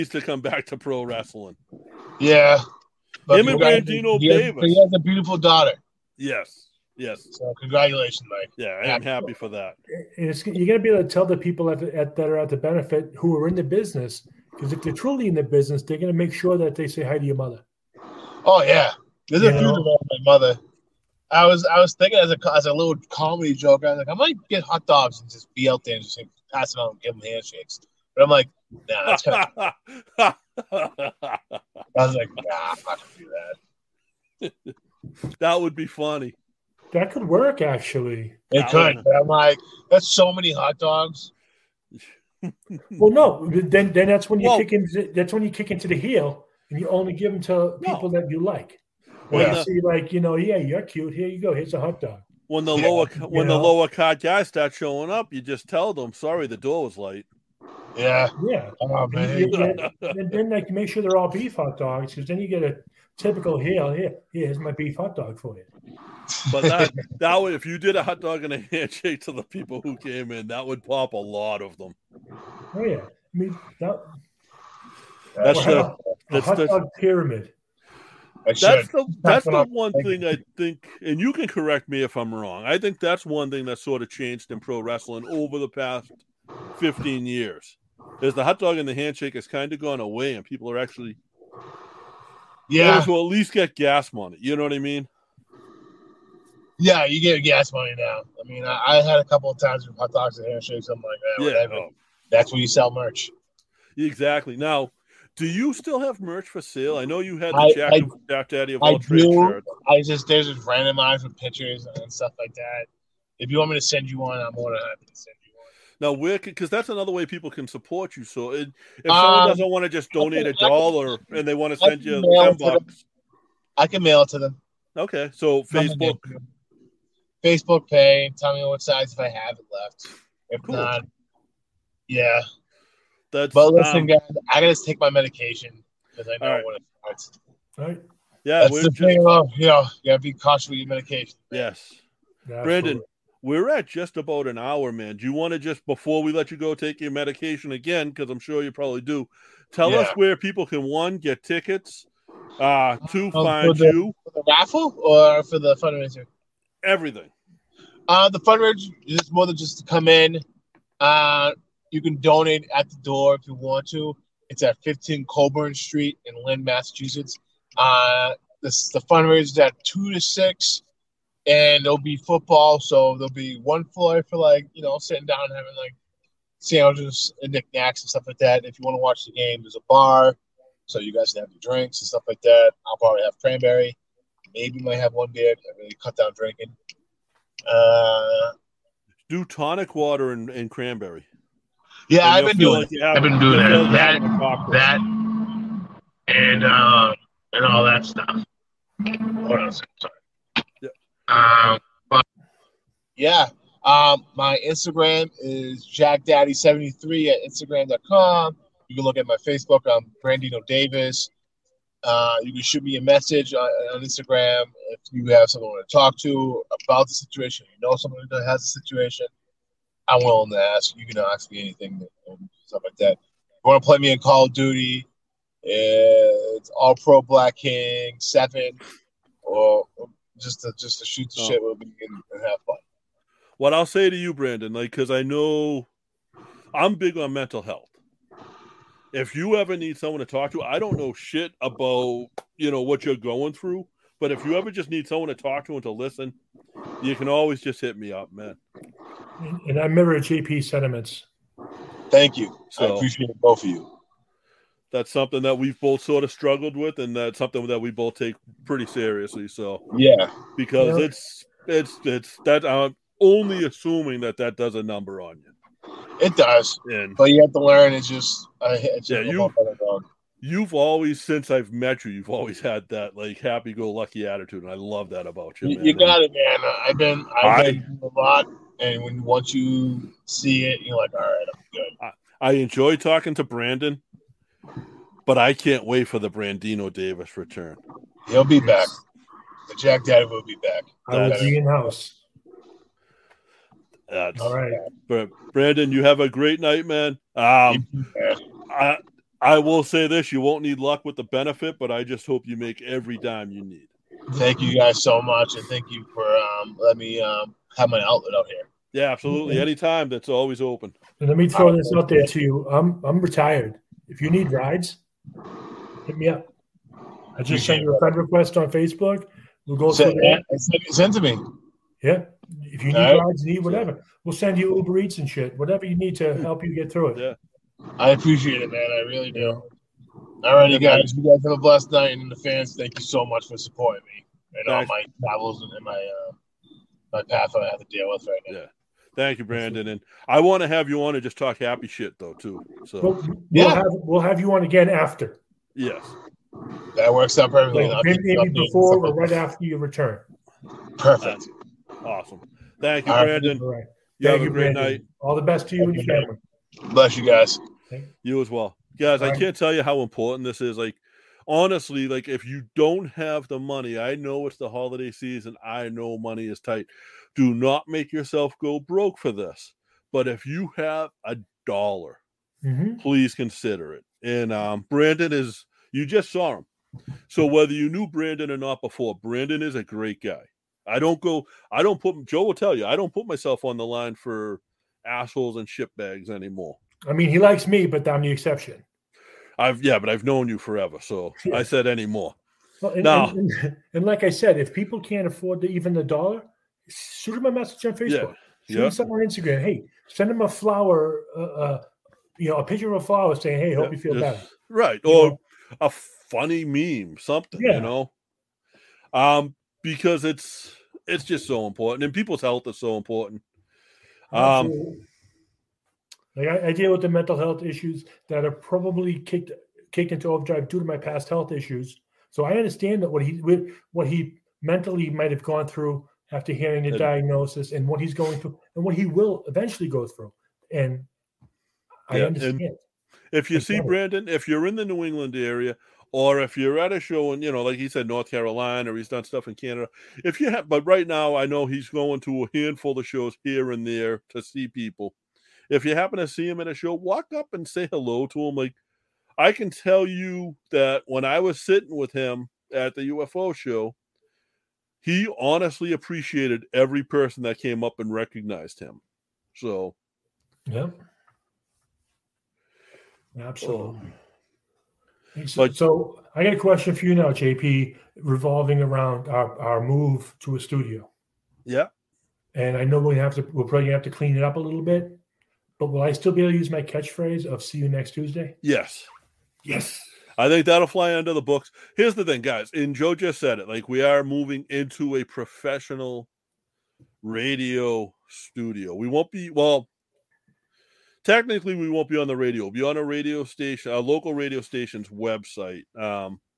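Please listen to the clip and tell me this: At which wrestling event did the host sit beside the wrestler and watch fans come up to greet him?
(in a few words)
The UFO show.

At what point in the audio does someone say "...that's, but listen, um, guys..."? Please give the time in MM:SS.
02:13.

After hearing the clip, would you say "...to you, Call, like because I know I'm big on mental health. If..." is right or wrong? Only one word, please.
wrong.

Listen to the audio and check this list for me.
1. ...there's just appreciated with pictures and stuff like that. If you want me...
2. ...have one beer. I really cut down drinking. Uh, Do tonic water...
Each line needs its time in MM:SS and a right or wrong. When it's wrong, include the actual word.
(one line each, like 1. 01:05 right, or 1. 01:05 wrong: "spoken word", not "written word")
1. 01:50 wrong: "randomized", not "appreciated"
2. 03:04 right.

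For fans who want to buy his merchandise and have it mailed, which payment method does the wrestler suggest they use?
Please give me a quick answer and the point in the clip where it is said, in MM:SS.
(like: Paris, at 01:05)
Facebook Pay, at 02:07.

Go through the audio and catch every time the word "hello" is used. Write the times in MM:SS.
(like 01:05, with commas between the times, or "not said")
07:27.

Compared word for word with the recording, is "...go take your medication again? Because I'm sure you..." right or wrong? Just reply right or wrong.
right.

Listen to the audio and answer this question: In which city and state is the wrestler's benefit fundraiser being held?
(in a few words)
Lynn, Massachusetts.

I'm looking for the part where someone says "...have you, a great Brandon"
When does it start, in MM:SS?
05:54.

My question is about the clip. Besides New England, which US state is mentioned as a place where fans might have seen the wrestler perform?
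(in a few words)
North Carolina.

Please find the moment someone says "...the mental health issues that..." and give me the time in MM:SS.
06:57.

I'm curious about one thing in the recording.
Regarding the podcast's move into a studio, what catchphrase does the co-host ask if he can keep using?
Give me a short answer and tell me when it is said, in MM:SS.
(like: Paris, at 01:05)
See you next Tuesday, at 07:57.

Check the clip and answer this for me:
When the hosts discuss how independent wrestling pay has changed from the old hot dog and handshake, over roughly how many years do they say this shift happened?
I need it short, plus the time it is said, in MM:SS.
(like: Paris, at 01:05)
15 years, at 01:26.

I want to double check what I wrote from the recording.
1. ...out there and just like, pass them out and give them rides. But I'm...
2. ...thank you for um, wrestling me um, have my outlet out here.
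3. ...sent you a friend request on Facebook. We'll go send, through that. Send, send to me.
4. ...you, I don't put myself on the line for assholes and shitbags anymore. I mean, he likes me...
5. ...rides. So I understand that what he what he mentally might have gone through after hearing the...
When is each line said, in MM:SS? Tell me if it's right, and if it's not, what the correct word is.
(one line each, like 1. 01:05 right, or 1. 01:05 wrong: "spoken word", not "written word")
1. 00:25 wrong: "handshakes", not "rides"
2. 05:05 wrong: "letting", not "wrestling"
3. 05:17 right
4. 06:22 right
5. 07:01 wrong: "issues", not "rides".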